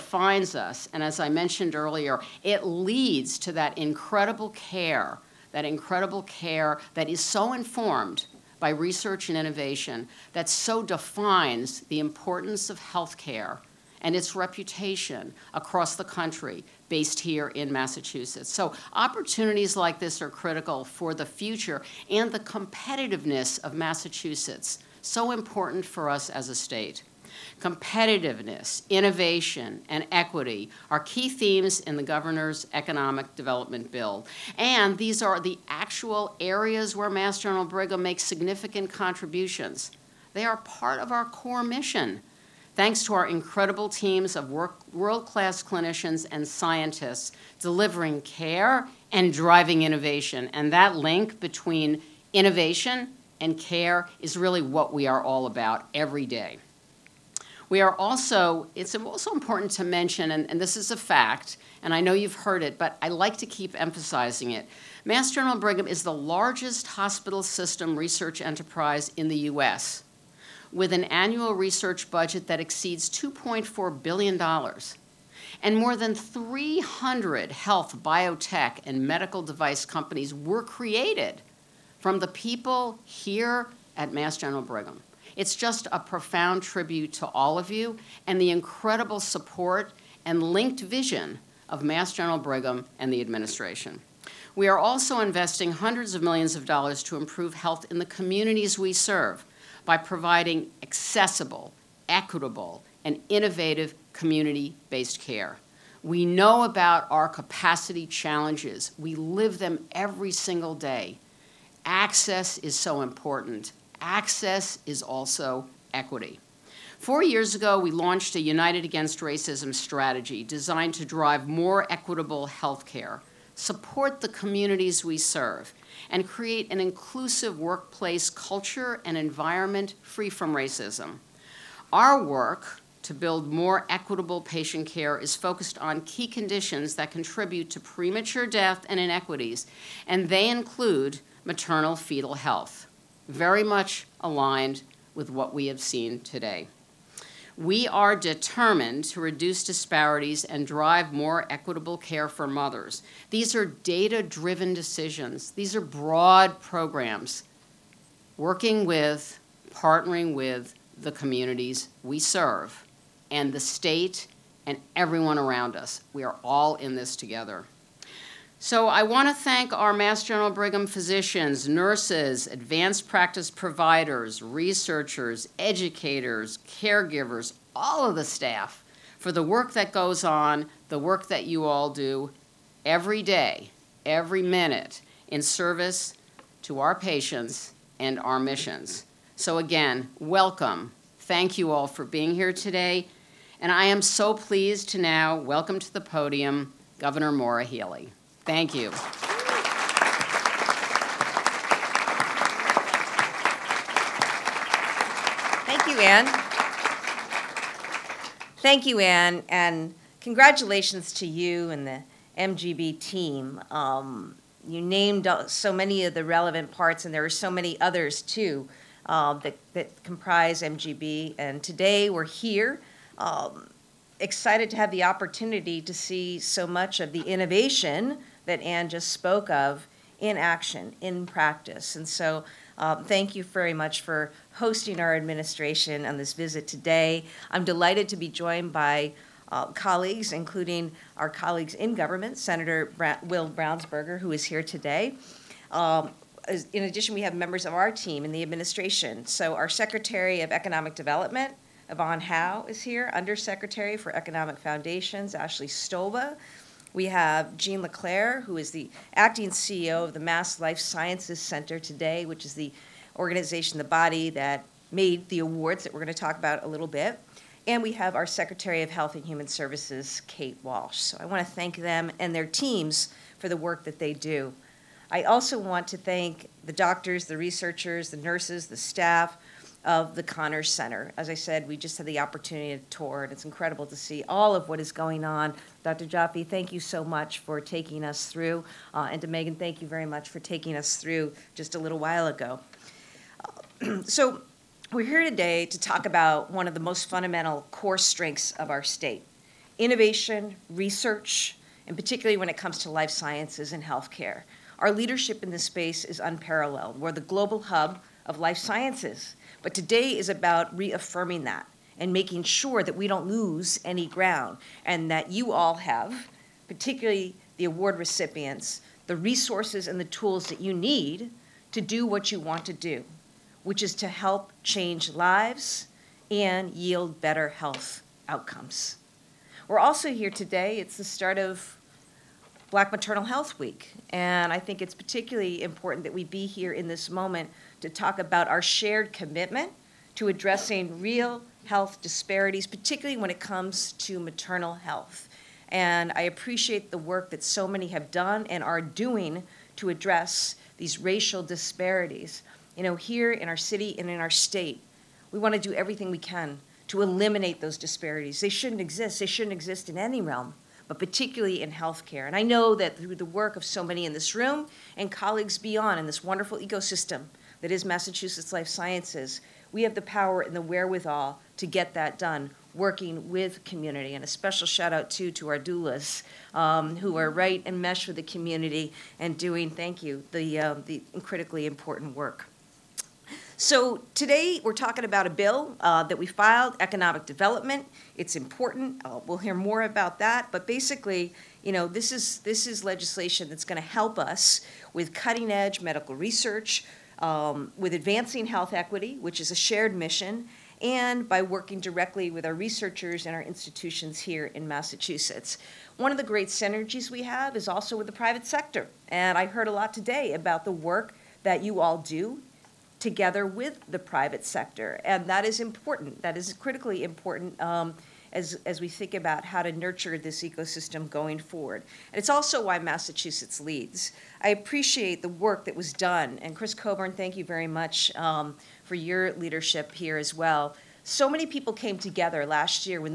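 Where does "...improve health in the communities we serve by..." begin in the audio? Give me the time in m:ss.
1:37.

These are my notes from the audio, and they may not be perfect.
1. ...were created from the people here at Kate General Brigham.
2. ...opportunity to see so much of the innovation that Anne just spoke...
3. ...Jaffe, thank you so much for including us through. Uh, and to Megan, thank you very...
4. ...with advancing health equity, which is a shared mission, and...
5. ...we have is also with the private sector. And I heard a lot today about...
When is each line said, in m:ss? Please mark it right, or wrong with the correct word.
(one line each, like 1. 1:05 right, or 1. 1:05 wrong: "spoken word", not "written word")
1. 1:20 wrong: "Mass", not "Kate"
2. 3:45 right
3. 4:46 wrong: "taking", not "including"
4. 6:37 right
5. 6:47 right.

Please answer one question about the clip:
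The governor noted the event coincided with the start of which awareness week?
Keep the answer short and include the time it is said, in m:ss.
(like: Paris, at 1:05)
Black Maternal Health Week, at 5:32.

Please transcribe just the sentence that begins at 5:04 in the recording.
Our leadership in this space is unparalleled.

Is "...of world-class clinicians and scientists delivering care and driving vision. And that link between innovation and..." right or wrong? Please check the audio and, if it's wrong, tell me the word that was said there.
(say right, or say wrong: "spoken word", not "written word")
wrong: "innovation", not "vision".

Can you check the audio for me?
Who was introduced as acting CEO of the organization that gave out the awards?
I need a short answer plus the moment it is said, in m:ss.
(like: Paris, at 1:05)
Jean LeClaire, at 4:17.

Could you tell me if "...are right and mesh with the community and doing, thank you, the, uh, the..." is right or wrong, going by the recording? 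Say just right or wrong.
right.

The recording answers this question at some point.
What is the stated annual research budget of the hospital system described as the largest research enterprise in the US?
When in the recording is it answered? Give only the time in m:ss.
1:13.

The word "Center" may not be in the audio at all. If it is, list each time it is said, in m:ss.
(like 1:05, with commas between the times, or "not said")
4:21, 4:40.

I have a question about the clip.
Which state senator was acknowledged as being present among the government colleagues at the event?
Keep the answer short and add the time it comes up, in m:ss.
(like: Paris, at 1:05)
Will Brownsberger, at 4:03.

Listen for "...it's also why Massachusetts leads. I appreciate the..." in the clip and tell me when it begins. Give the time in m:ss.
7:02.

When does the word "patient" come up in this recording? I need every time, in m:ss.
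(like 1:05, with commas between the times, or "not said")
2:14, 3:06.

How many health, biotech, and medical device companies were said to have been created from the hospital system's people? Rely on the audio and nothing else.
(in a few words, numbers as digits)
300.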